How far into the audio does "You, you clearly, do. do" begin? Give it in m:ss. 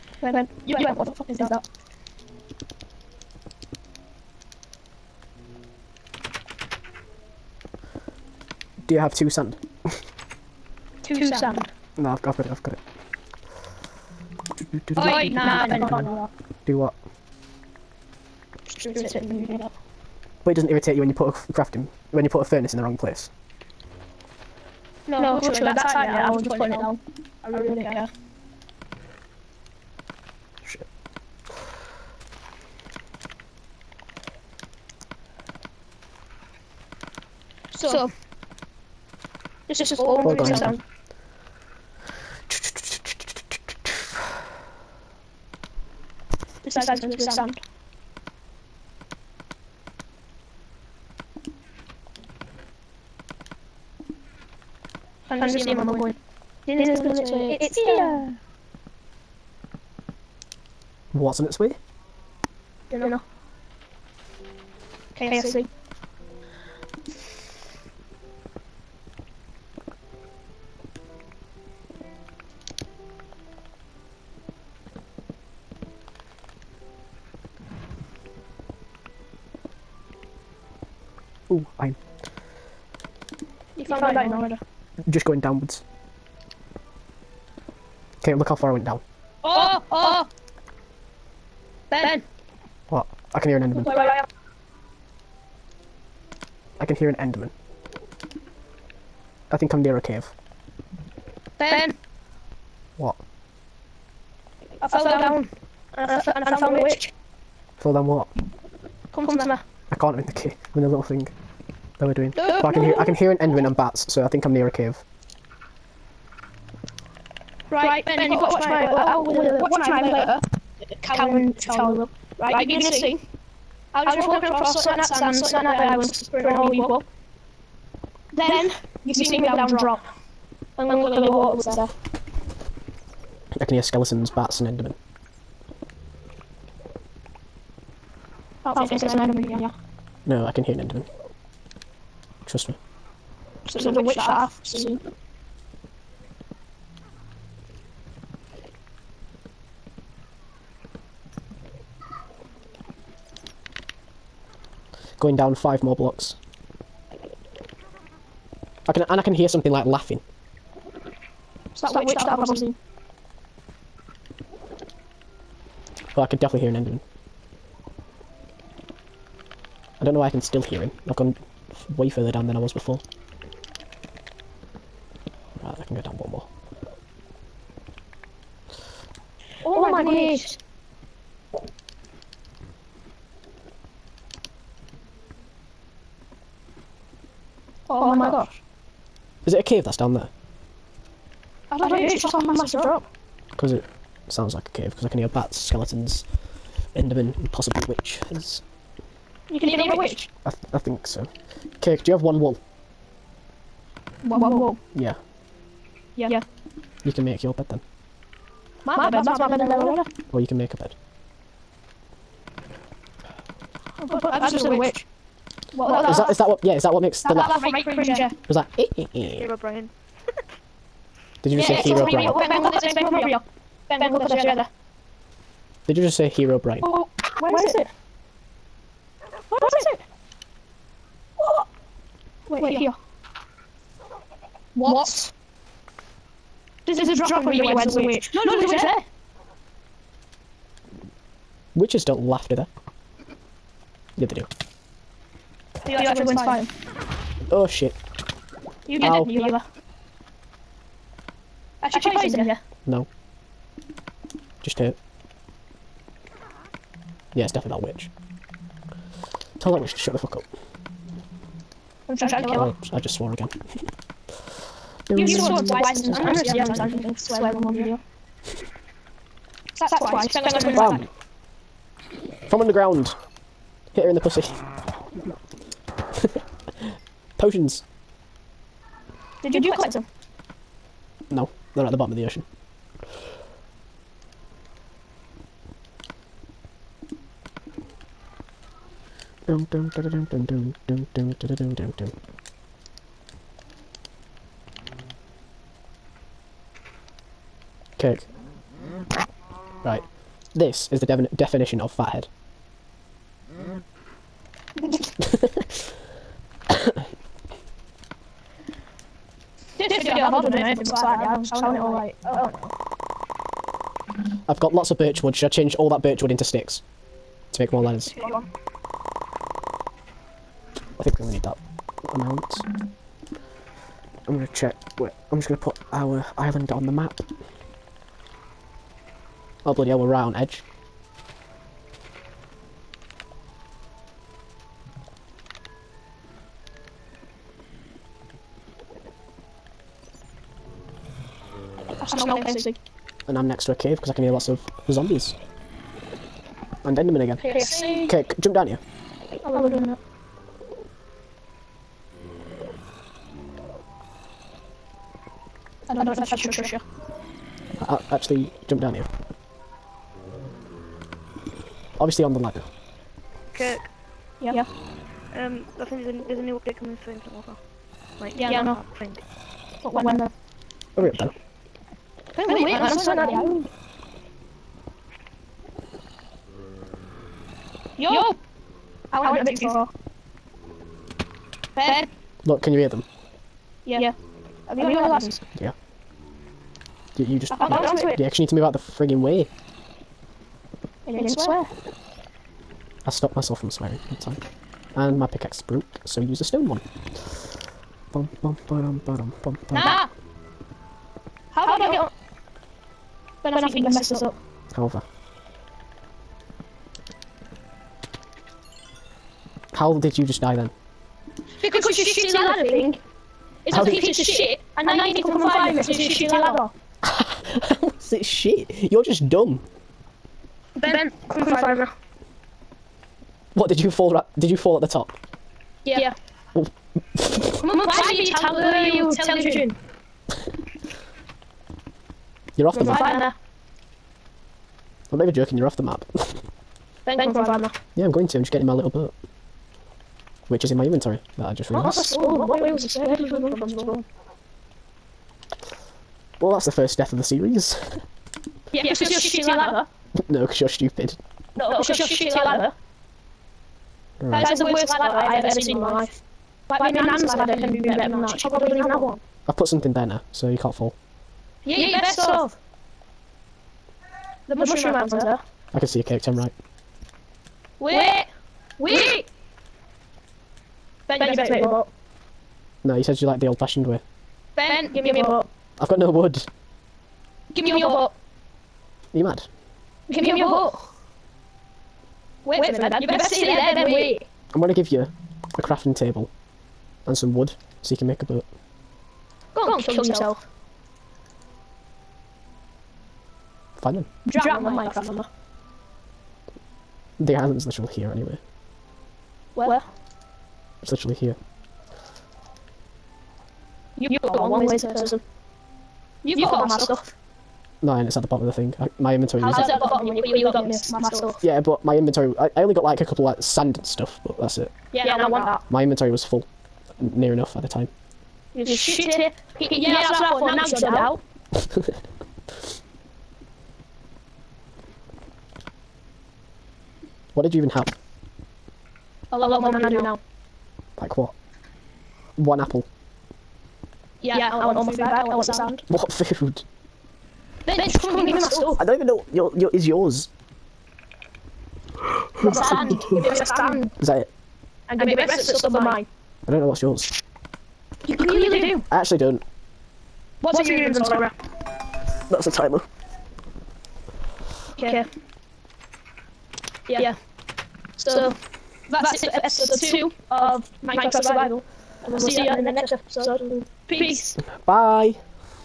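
9:08.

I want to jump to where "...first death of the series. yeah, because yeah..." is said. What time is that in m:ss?
7:26.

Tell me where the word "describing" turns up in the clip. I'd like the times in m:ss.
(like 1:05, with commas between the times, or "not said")
not said.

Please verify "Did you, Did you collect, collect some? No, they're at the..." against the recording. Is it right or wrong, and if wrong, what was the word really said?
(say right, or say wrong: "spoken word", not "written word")
right.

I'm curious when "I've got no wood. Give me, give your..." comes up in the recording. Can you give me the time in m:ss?
7:55.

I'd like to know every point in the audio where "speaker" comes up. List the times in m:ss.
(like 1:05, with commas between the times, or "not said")
not said.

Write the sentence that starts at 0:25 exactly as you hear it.
No, no literally, that time, yeah, I was just putting it down.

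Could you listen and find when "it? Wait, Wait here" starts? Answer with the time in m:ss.
3:51.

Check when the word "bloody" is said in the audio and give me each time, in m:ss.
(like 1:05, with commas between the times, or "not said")
5:29.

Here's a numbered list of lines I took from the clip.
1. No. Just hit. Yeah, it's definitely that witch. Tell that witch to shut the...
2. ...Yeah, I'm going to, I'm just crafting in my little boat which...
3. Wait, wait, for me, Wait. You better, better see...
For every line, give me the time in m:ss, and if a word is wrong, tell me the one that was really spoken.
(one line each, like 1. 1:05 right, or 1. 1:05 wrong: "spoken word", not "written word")
1. 4:12 right
2. 7:17 wrong: "getting", not "crafting"
3. 8:02 wrong: "Dad", not "Wait".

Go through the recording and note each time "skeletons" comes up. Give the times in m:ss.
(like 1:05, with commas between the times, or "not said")
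2:13, 3:15.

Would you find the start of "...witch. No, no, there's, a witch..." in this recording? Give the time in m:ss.
3:58.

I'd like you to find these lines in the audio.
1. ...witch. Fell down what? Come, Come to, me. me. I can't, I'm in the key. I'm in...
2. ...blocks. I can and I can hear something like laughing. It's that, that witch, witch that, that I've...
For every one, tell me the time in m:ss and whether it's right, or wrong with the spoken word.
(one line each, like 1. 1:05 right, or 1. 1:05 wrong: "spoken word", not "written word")
1. 1:46 right
2. 2:35 right.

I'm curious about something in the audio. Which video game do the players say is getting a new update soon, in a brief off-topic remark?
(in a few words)
Infinite Warfare.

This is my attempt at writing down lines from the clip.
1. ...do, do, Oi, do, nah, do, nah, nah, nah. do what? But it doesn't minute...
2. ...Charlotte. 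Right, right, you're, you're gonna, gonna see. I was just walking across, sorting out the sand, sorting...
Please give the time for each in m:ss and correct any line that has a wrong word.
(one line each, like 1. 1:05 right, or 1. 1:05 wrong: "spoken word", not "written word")
1. 0:14 wrong: "irritate", not "minute"
2. 2:01 right.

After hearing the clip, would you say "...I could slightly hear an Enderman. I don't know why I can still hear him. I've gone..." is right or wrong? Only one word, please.
wrong.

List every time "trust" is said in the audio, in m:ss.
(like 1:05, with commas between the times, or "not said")
2:22, 5:56.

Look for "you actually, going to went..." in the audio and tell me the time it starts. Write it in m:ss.
4:05.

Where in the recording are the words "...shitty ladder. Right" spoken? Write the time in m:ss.
7:32.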